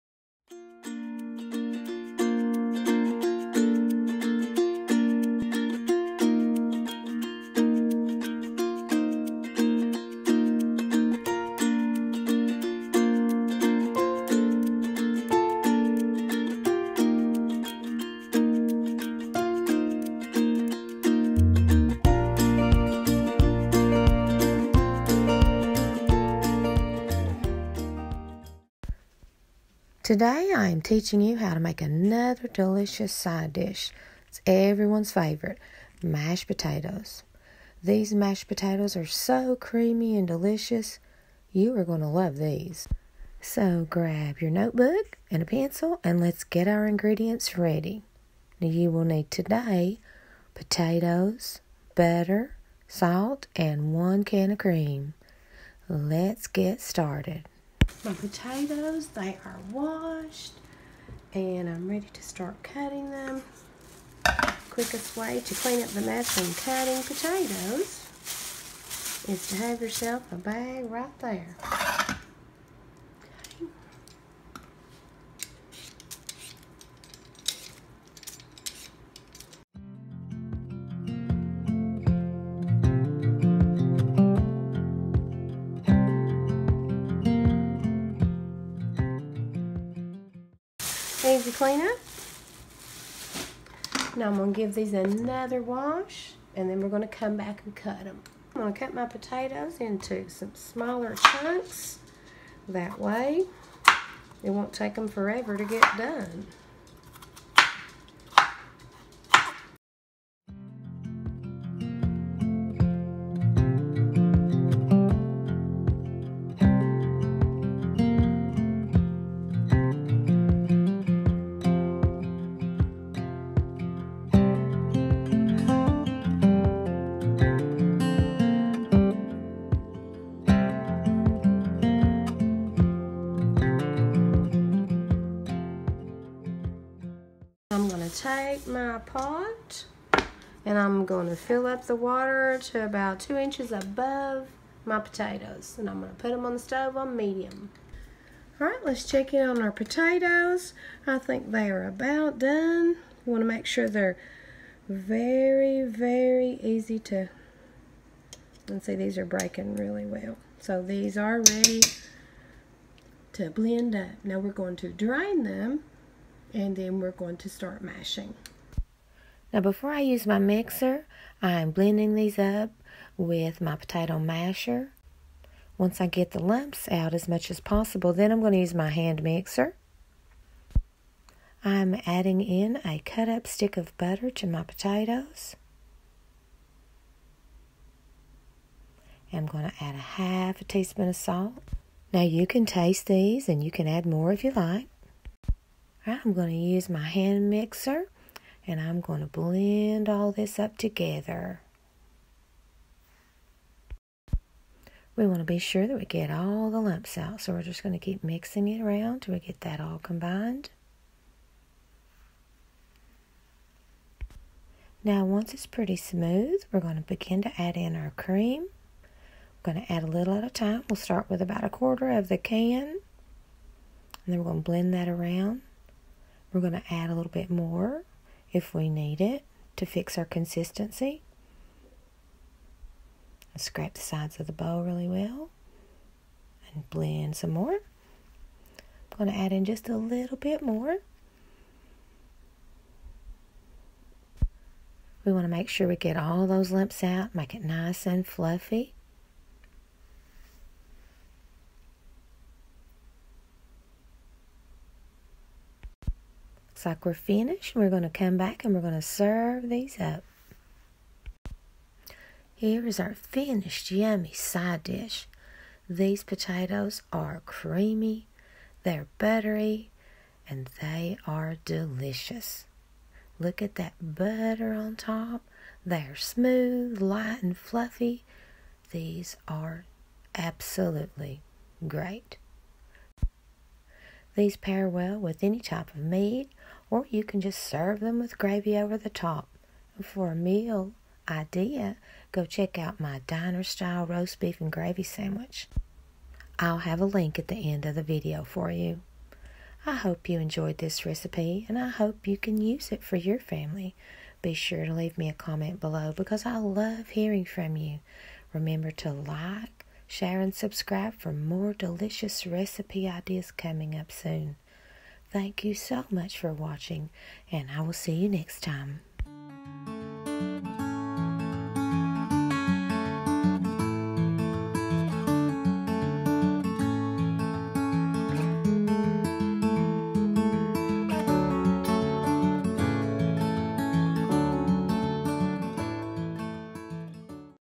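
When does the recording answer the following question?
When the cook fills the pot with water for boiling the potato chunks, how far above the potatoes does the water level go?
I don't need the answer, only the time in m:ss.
2:23.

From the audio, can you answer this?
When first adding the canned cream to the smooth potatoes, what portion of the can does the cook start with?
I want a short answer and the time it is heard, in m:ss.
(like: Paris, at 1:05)
A quarter, at 3:41.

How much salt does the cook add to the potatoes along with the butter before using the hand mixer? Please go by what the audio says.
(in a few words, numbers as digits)
Half a teaspoon.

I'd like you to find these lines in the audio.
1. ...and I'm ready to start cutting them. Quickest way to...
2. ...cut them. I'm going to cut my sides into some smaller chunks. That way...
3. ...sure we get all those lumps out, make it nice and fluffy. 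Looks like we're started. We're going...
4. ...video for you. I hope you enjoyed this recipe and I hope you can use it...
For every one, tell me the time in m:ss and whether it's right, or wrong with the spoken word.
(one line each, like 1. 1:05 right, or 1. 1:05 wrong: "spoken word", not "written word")
1. 1:01 right
2. 1:37 wrong: "potatoes", not "sides"
3. 4:05 wrong: "finished", not "started"
4. 4:58 right.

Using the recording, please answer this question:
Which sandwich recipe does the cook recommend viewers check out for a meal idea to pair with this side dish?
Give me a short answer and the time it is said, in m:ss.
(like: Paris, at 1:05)
Diner style roast beef and gravy sandwich, at 4:53.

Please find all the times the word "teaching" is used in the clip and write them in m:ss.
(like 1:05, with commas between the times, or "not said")
0:30.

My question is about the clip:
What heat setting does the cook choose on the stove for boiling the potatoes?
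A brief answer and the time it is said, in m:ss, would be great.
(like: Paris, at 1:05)
Medium, at 2:27.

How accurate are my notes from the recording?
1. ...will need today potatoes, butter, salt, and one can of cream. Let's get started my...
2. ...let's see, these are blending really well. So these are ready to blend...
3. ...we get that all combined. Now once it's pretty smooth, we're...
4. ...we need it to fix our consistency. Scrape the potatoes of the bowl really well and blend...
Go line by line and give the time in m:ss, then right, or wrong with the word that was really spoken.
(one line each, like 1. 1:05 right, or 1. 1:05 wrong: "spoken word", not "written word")
1. 0:48 right
2. 2:38 wrong: "breaking", not "blending"
3. 3:29 right
4. 3:48 wrong: "sides", not "potatoes".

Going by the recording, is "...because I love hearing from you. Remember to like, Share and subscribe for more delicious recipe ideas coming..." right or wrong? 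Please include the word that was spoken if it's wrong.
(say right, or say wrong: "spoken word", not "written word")
right.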